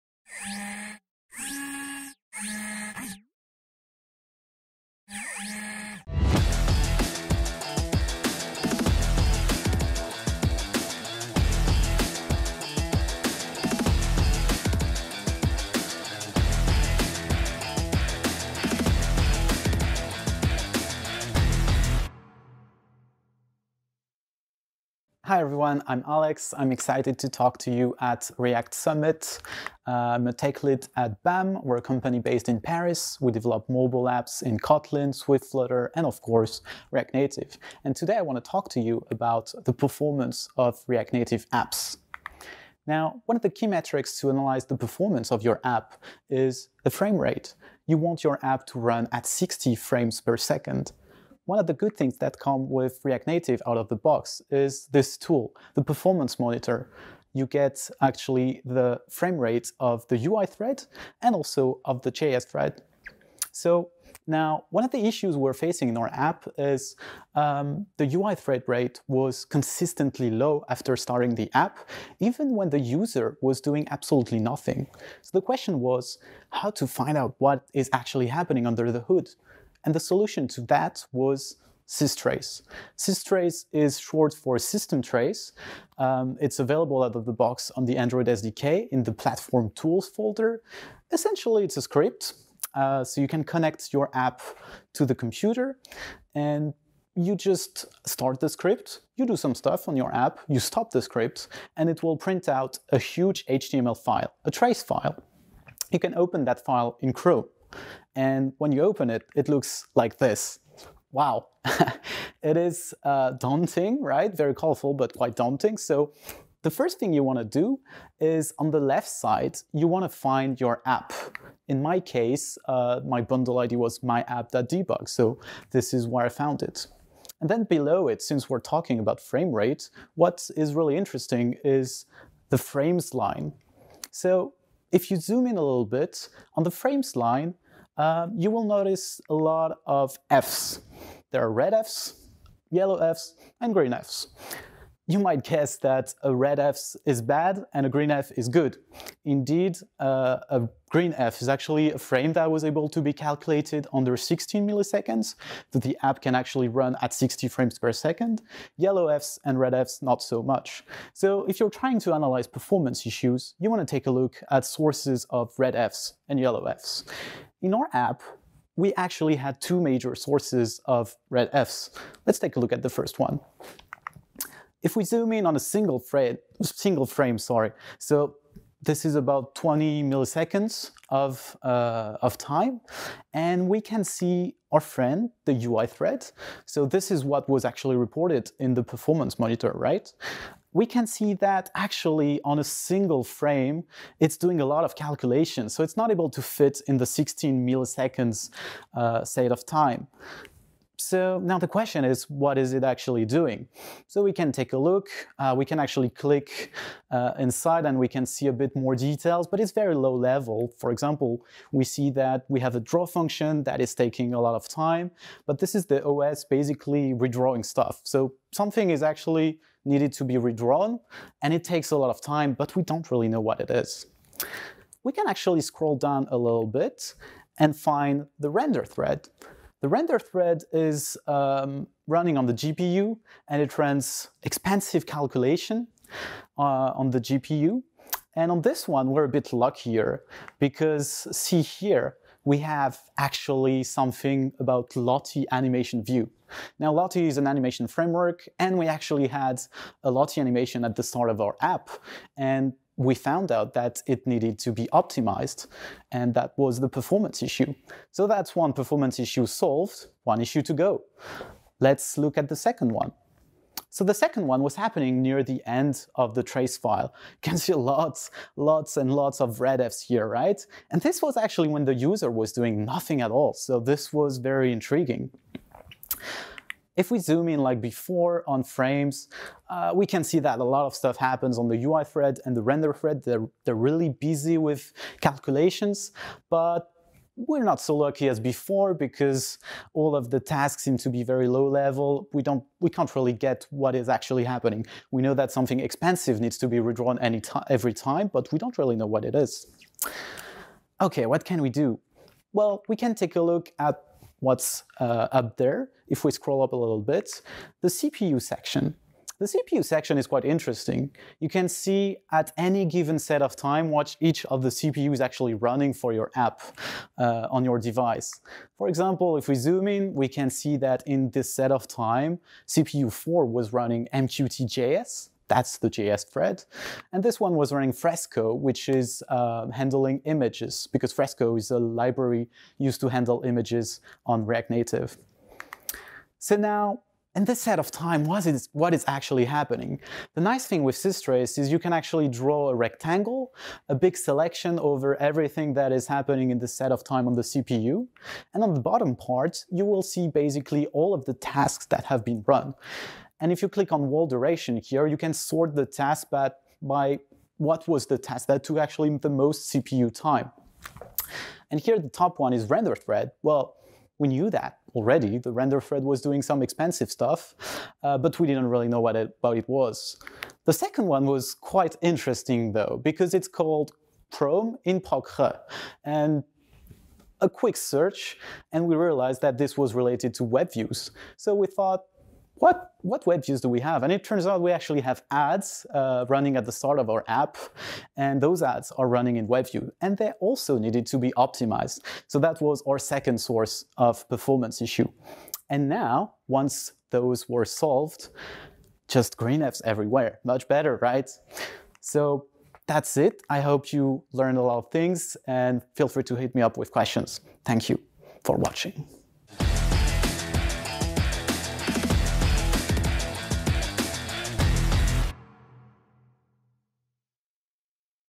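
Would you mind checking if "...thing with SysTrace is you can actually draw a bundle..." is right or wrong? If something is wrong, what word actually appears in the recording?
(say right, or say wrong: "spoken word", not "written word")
wrong: "rectangle", not "bundle".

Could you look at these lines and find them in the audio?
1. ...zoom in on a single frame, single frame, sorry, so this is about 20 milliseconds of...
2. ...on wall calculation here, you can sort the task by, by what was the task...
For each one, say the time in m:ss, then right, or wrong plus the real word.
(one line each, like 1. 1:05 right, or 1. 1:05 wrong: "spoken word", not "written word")
1. 2:55 right
2. 5:53 wrong: "duration", not "calculation".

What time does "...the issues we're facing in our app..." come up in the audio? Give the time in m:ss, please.
1:04.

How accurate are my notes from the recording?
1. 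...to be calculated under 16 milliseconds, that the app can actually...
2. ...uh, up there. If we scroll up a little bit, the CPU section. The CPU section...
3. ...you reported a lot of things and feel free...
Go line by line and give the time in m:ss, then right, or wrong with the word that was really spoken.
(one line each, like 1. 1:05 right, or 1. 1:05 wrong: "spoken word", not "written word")
1. 2:32 right
2. 5:04 right
3. 6:43 wrong: "learned", not "reported".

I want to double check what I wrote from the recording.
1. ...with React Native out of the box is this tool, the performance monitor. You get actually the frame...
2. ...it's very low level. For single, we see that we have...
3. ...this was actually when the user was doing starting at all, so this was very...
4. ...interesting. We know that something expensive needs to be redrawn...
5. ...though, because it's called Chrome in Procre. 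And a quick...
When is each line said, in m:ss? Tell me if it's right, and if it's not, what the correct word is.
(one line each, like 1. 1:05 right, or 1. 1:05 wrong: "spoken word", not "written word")
1. 0:52 right
2. 3:29 wrong: "example", not "single"
3. 4:31 wrong: "nothing", not "starting"
4. 4:54 wrong: "happening", not "interesting"
5. 6:12 right.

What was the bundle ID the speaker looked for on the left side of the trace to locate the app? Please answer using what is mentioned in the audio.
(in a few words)
myapp.debug.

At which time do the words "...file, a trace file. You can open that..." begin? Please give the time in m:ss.
1:44.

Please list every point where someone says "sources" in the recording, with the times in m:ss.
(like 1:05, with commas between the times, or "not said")
2:44, 2:50, 6:33.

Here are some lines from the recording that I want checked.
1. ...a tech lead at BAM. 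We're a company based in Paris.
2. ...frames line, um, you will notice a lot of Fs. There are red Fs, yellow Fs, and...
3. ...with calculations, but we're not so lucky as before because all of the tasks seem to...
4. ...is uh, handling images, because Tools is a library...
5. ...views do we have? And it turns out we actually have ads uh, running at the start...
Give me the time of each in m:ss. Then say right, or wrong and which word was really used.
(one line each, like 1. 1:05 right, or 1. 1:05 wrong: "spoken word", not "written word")
1. 0:30 right
2. 2:16 right
3. 4:44 right
4. 5:28 wrong: "Fresco", not "Tools"
5. 6:23 right.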